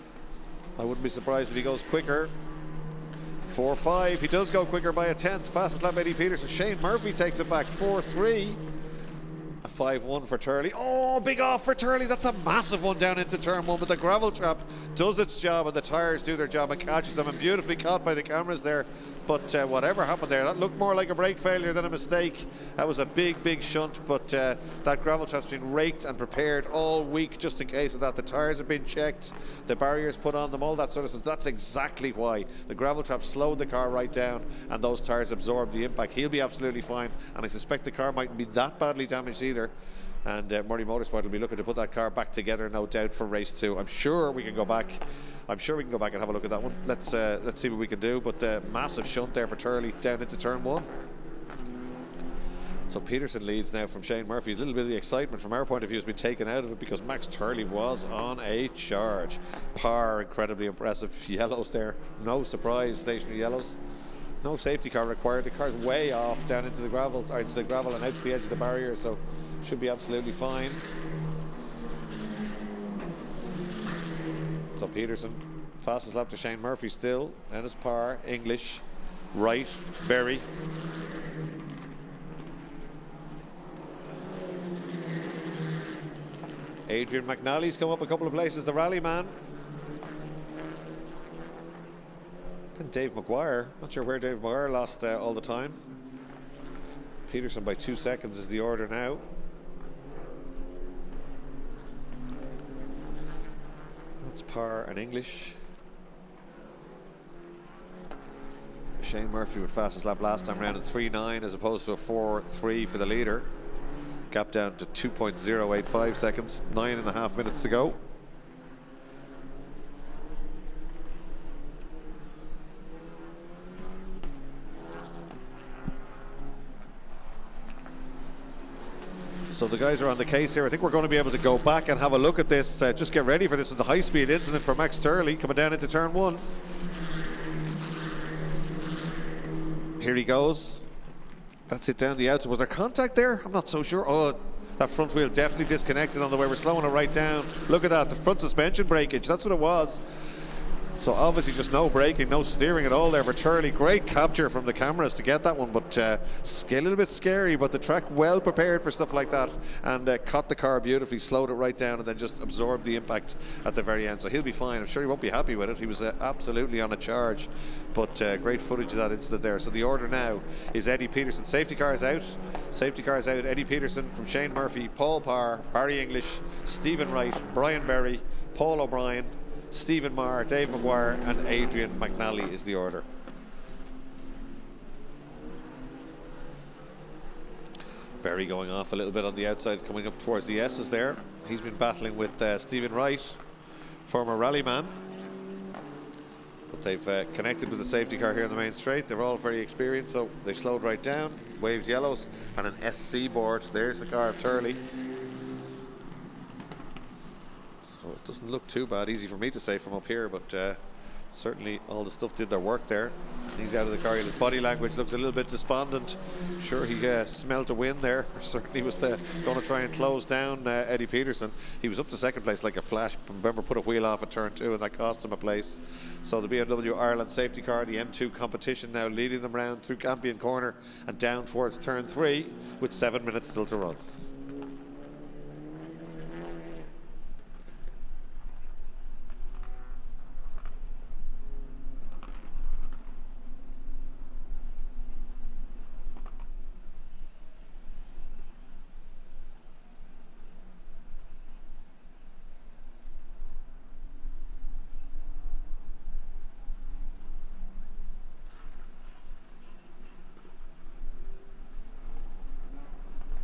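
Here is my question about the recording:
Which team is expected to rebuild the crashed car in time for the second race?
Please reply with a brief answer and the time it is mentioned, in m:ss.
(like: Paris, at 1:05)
Murray Motorsport, at 0:40.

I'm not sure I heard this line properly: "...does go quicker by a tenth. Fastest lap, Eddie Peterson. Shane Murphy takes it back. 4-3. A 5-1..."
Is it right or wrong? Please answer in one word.
right.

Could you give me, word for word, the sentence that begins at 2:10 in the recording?
I think we're going to be able to go back and have a look at this.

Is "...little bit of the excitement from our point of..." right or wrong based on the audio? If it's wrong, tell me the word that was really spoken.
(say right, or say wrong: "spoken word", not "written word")
right.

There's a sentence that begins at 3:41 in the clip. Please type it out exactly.
He was up to second place like a flash.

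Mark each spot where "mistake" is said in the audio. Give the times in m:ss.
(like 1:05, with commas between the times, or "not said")
0:21.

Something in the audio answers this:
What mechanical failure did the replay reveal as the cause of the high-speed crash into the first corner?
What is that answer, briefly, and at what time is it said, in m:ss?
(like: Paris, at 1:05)
Front suspension breakage, at 2:28.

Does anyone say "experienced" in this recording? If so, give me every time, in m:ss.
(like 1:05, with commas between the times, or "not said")
3:19.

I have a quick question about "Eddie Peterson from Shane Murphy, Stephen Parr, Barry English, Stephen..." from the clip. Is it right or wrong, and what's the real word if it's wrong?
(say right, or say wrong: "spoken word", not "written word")
wrong: "Paul", not "Stephen".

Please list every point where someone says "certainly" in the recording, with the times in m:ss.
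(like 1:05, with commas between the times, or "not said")
3:31, 3:38.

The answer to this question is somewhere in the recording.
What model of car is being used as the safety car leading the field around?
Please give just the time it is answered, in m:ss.
3:47.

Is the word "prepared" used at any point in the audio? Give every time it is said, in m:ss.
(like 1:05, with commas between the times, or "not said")
0:26, 2:38.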